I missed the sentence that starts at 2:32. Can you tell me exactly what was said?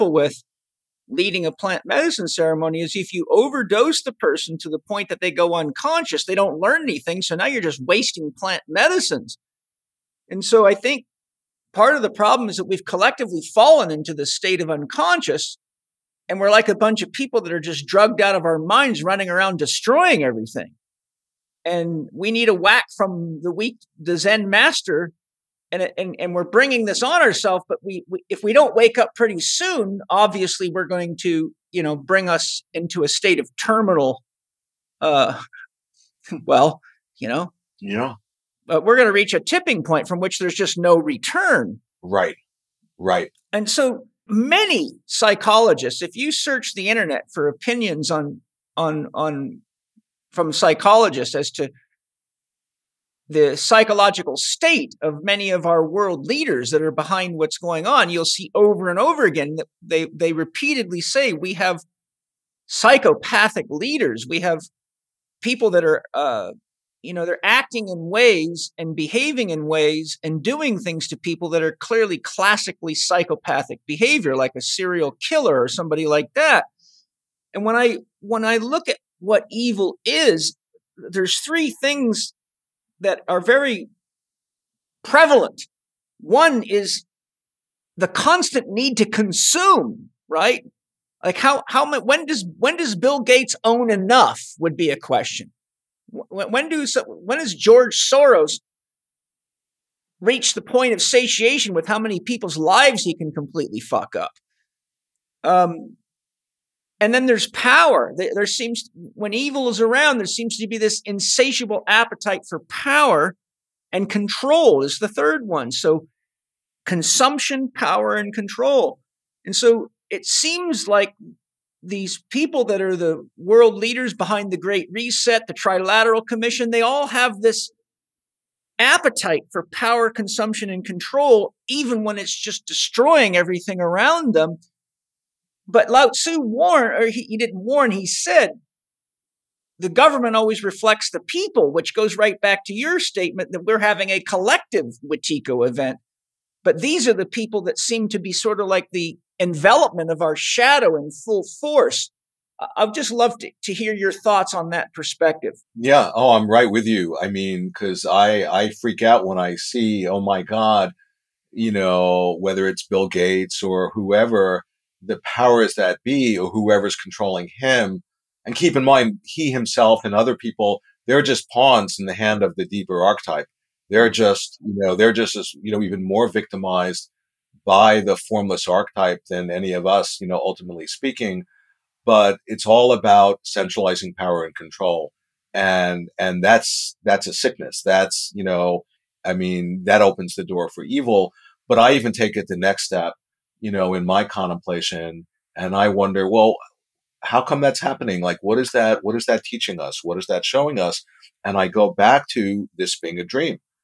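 I'd just love to, to hear your thoughts on that perspective.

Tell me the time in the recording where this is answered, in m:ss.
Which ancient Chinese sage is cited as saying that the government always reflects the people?
2:15.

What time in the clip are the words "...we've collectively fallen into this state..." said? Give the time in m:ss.
0:12.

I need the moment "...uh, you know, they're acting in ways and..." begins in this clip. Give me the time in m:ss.
1:06.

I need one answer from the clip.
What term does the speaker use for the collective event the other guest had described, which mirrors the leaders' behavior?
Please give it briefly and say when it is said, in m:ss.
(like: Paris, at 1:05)
Wetiko, at 2:25.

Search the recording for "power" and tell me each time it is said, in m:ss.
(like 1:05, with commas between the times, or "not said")
1:47, 1:52, 1:57, 2:09, 2:45, 3:04.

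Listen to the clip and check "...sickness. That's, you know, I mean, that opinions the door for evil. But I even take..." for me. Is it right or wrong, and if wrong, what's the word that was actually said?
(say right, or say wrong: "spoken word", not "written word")
wrong: "opens", not "opinions".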